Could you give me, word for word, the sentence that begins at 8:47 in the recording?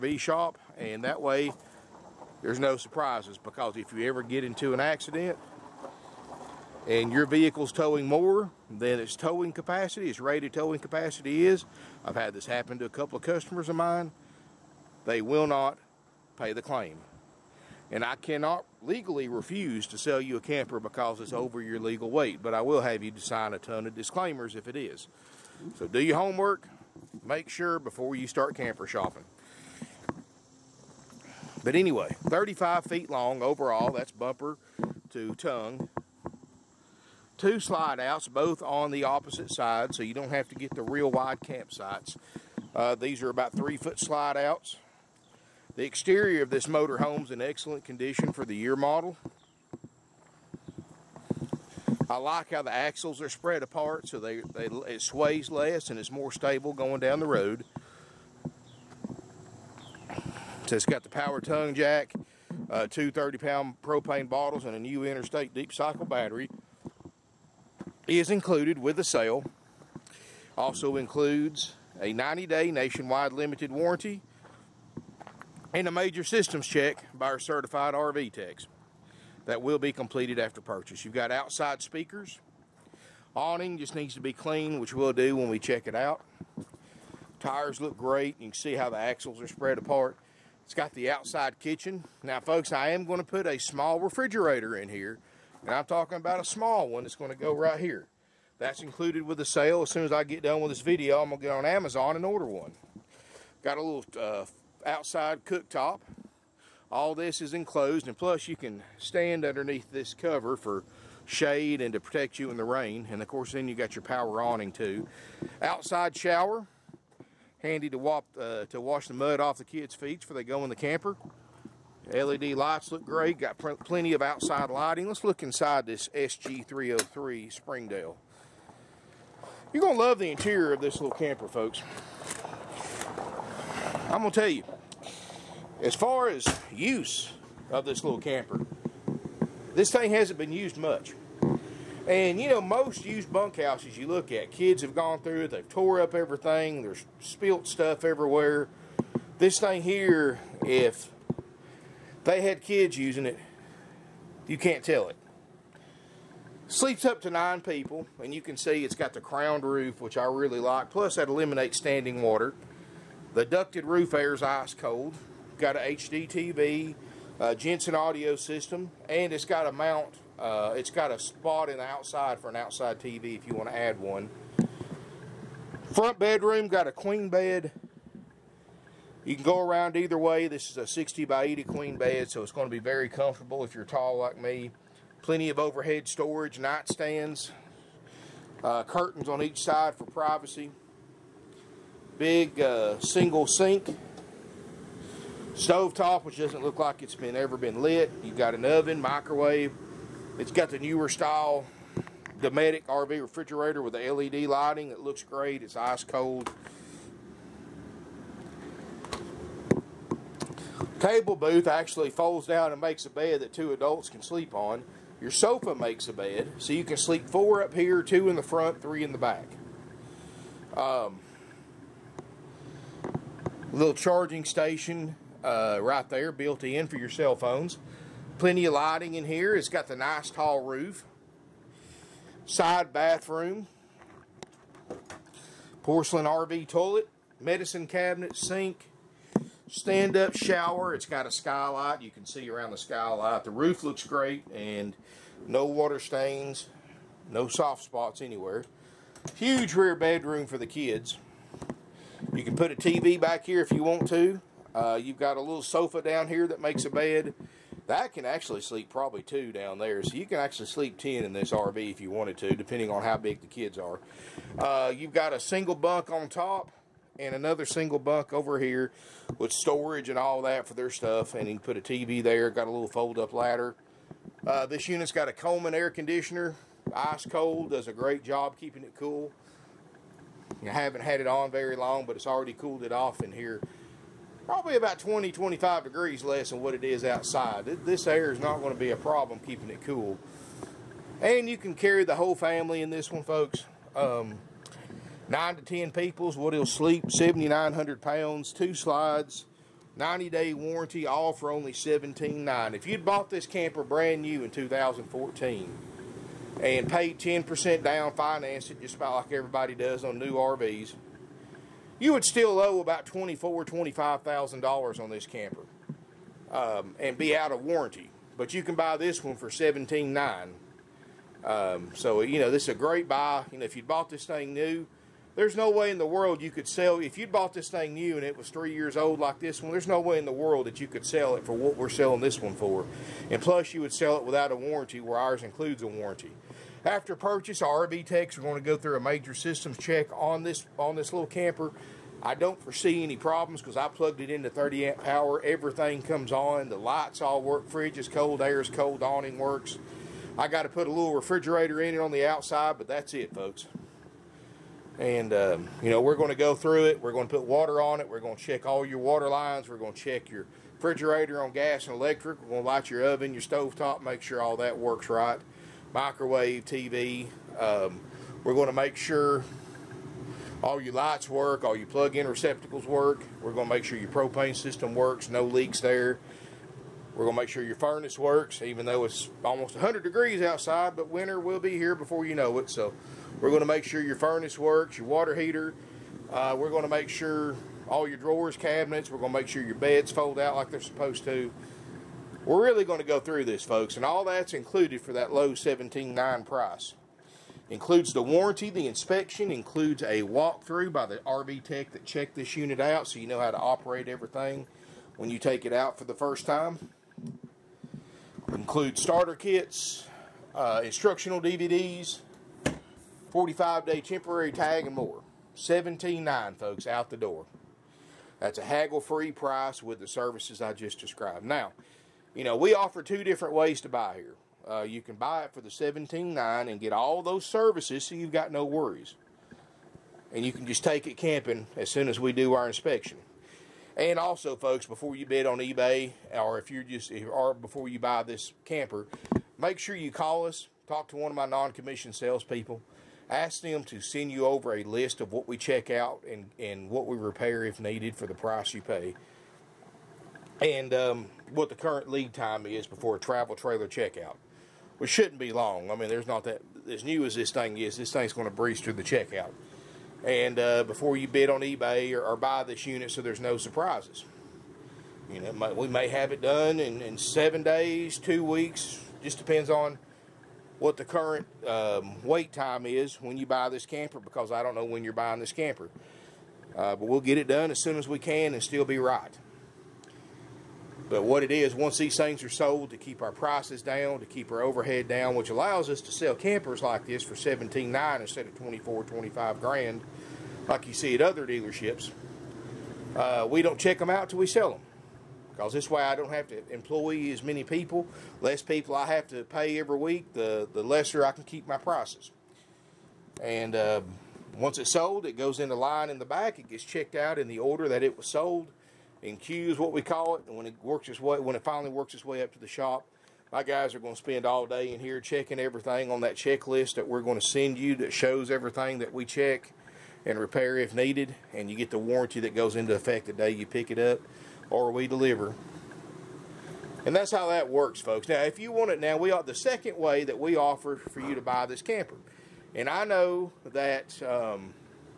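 And that's how that works, folks.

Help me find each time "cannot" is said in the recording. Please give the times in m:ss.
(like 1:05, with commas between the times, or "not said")
0:18.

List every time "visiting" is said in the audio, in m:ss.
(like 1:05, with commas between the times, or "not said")
not said.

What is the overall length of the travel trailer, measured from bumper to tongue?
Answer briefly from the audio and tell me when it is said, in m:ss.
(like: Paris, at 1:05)
35 feet, at 0:32.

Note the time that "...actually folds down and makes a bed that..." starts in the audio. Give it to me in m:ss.
3:31.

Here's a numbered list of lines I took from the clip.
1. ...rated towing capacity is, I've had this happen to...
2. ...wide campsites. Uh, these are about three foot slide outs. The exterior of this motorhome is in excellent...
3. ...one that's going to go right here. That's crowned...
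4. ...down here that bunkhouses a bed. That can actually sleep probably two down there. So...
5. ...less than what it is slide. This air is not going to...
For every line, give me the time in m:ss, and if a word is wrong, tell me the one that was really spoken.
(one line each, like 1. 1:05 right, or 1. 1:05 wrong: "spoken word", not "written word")
1. 0:10 right
2. 0:41 right
3. 1:36 wrong: "included", not "crowned"
4. 4:16 wrong: "makes", not "bunkhouses"
5. 4:46 wrong: "outside", not "slide".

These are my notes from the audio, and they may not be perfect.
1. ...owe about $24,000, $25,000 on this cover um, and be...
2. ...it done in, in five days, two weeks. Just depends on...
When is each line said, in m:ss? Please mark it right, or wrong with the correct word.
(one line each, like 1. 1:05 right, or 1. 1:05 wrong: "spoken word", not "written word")
1. 5:12 wrong: "camper", not "cover"
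2. 7:46 wrong: "seven", not "five".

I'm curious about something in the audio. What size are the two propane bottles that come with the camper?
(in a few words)
30-pound.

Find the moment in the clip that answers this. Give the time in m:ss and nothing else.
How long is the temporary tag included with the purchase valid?
6:53.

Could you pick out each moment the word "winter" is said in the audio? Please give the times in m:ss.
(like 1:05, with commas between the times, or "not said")
6:21.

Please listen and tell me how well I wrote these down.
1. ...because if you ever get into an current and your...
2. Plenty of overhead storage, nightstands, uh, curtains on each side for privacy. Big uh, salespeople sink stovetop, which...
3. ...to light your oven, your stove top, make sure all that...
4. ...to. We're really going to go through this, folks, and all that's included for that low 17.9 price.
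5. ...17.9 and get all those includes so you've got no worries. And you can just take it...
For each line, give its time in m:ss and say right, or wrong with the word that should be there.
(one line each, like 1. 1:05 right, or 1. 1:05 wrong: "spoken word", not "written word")
1. 0:03 wrong: "accident", not "current"
2. 3:05 wrong: "single", not "salespeople"
3. 6:02 right
4. 6:31 right
5. 7:05 wrong: "services", not "includes".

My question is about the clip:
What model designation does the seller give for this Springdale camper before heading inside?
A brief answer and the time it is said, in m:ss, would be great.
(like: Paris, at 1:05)
SG303, at 2:06.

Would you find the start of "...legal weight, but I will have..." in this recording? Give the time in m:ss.
0:21.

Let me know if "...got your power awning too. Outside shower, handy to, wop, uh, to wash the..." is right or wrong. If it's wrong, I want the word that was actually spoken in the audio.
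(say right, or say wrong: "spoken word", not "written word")
right.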